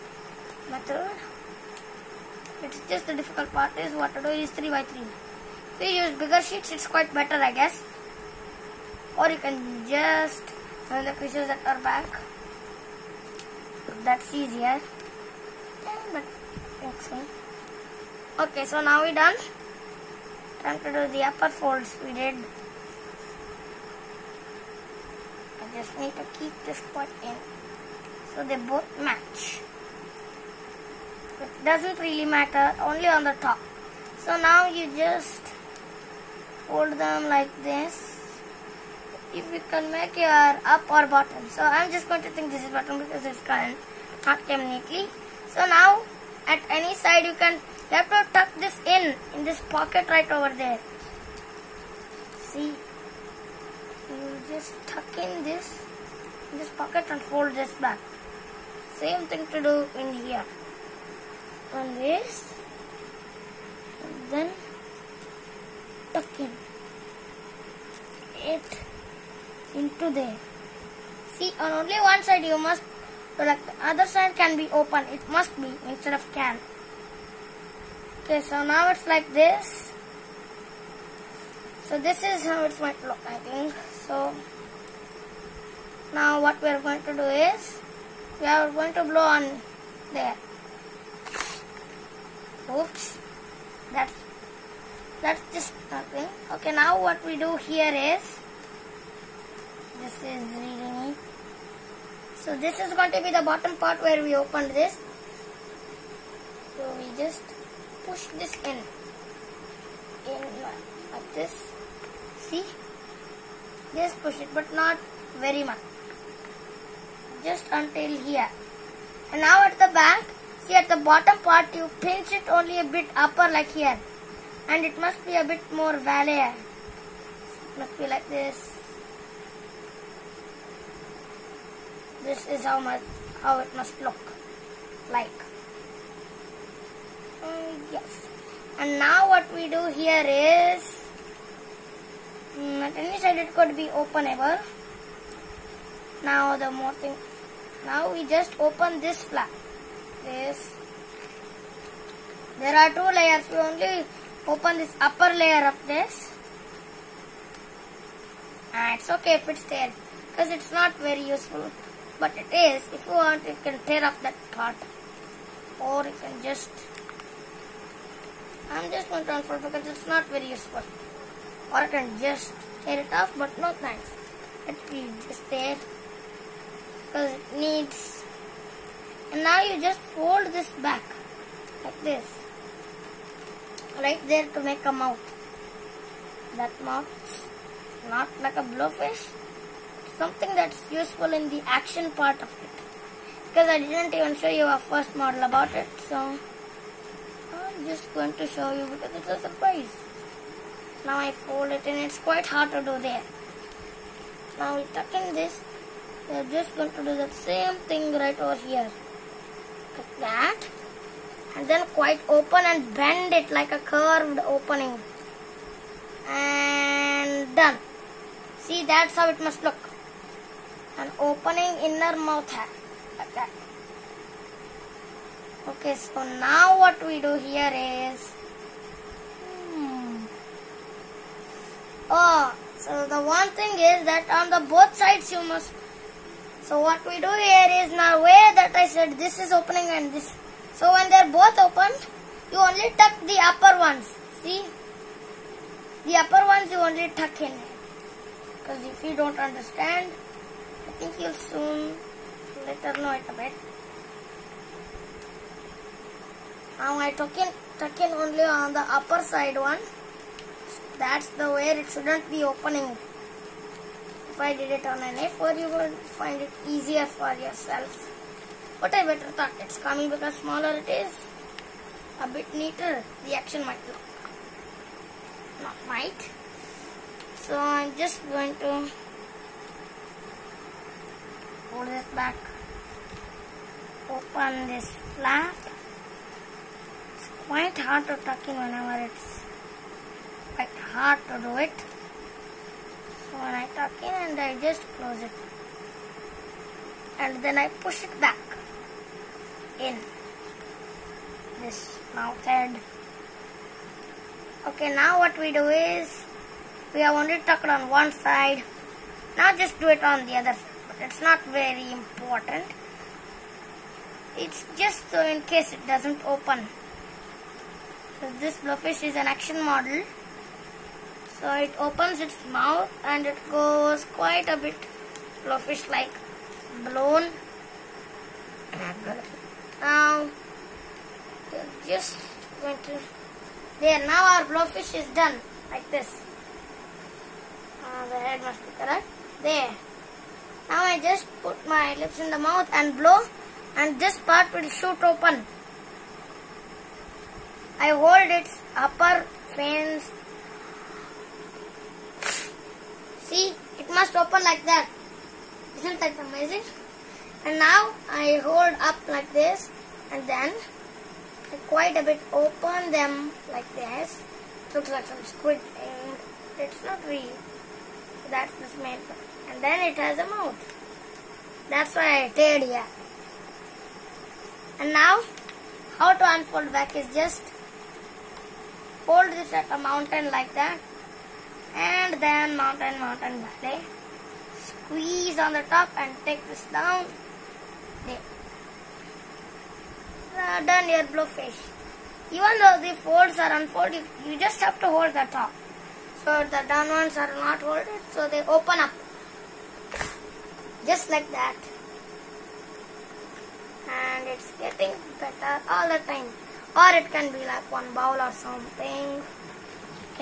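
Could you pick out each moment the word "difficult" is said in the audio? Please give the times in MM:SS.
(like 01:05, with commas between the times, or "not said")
00:03.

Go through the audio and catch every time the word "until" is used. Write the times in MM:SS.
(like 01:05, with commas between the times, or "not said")
01:57.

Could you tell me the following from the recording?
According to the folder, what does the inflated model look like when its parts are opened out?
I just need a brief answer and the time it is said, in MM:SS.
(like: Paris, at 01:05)
Squid, at 06:05.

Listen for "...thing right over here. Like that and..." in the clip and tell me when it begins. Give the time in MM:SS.
03:27.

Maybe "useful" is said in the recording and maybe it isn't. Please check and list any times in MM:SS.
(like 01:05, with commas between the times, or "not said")
02:41, 02:50, 03:10.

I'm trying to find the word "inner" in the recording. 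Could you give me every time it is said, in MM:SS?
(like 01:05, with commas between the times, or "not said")
03:41.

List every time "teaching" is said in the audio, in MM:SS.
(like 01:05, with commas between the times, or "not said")
not said.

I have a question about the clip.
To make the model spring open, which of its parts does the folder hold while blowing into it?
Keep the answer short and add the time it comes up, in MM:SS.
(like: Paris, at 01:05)
Upper fins, at 05:48.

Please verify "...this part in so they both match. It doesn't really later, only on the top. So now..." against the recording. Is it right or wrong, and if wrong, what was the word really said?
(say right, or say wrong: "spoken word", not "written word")
wrong: "matter", not "later".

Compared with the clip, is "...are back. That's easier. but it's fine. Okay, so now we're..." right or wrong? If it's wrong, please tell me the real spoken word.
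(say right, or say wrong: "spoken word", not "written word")
right.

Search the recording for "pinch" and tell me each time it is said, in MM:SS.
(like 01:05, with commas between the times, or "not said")
02:01.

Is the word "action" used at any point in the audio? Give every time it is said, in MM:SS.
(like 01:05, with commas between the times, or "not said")
03:11, 04:33, 05:19.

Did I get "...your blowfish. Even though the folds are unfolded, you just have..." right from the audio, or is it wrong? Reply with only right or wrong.
right.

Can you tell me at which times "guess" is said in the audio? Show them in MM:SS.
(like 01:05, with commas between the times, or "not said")
00:07.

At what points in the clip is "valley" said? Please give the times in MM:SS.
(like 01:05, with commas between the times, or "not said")
02:05, 06:23.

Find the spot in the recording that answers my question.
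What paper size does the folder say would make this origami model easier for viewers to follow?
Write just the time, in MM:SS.
04:25.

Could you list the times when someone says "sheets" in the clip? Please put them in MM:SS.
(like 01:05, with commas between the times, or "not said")
00:06.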